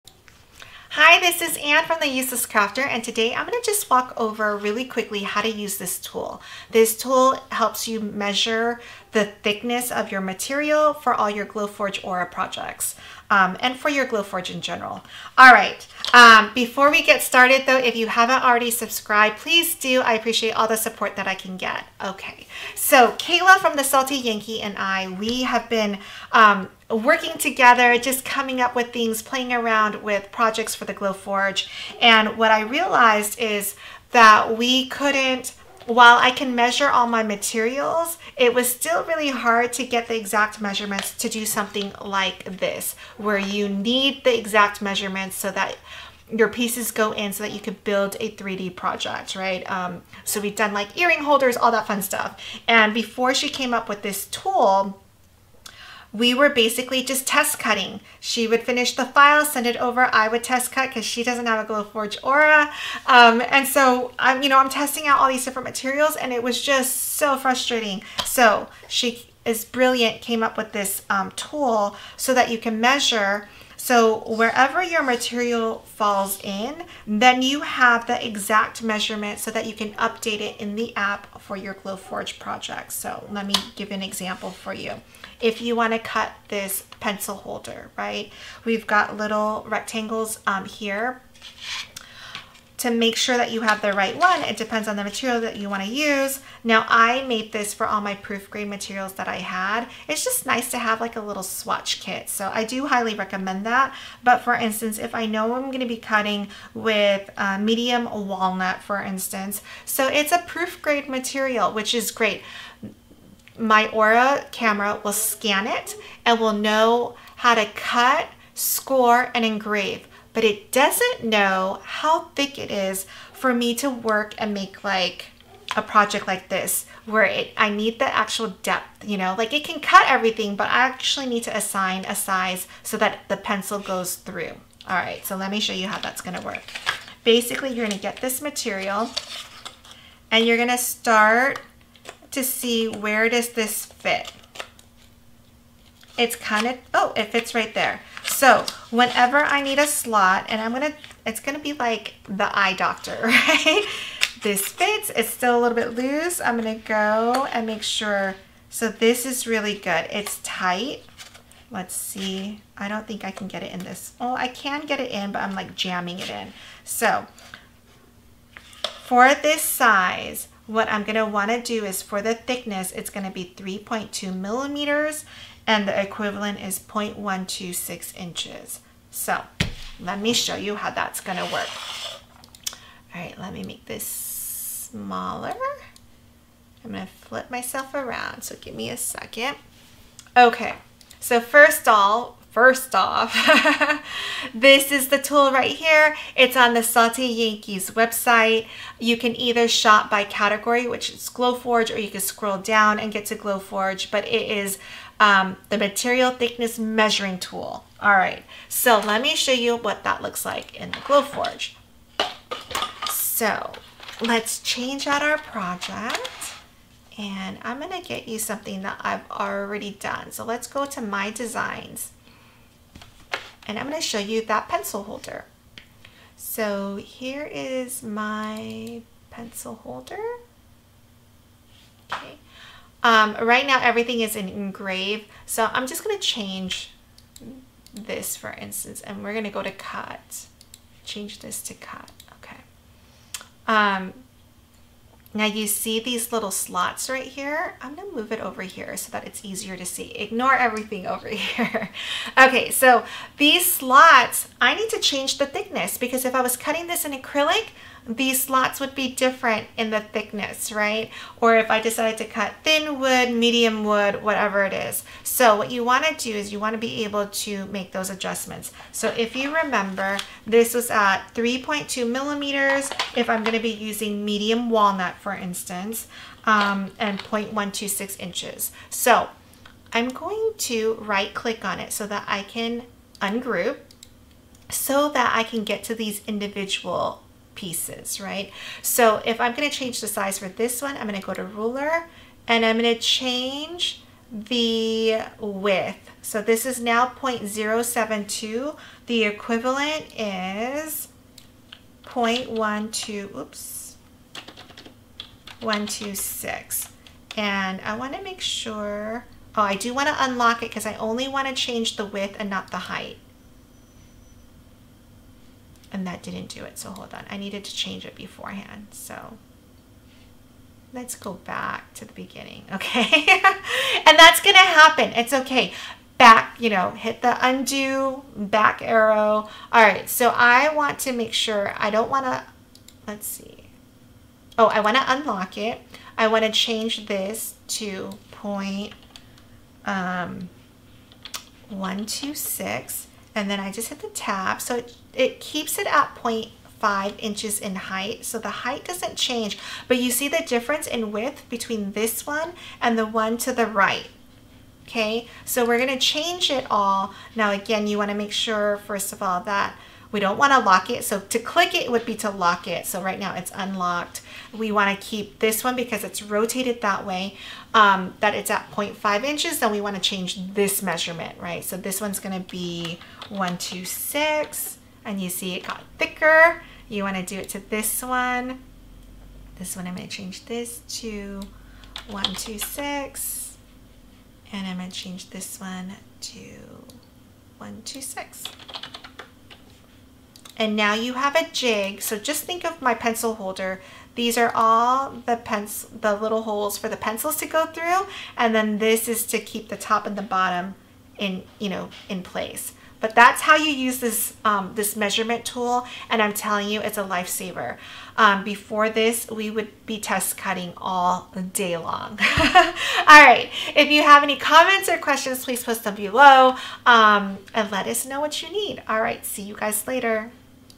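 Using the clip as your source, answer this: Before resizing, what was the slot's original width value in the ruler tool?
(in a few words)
0.072.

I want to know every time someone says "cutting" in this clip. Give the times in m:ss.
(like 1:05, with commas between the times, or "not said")
0:57, 1:45, 4:16, 6:50.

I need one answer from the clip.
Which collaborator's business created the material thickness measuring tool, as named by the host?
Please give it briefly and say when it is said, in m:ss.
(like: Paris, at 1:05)
The Salty Yankee, at 0:23.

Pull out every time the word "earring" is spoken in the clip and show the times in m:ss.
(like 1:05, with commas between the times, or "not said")
0:50.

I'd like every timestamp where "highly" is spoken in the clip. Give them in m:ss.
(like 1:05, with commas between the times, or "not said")
1:42.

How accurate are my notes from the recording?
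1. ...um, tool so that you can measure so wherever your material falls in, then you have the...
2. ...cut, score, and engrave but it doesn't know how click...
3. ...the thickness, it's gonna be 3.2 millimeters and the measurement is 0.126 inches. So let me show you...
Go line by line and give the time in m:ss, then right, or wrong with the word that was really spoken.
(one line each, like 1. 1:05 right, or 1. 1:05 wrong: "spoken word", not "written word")
1. 1:11 right
2. 1:57 wrong: "thick", not "click"
3. 2:52 wrong: "equivalent", not "measurement".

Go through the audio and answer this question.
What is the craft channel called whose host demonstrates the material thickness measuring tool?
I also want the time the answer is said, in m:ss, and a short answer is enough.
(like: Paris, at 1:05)
The Useless Crafter, at 0:02.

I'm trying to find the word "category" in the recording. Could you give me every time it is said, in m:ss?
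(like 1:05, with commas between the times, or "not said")
3:20.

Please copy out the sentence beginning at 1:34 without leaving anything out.
It depends on the material that you want to use.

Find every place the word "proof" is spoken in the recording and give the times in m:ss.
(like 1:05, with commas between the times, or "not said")
1:38, 1:50.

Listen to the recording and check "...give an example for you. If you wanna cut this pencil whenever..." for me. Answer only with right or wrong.
wrong.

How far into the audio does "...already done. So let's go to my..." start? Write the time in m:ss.
3:39.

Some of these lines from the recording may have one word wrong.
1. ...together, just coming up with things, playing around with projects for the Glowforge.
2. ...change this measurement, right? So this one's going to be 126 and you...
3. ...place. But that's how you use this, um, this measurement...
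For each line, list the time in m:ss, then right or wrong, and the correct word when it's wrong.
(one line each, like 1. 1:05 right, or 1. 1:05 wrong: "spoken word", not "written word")
1. 0:27 right
2. 6:10 right
3. 6:42 right.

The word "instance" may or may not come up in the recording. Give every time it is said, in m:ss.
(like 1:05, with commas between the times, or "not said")
1:44, 1:48, 3:58, 4:35.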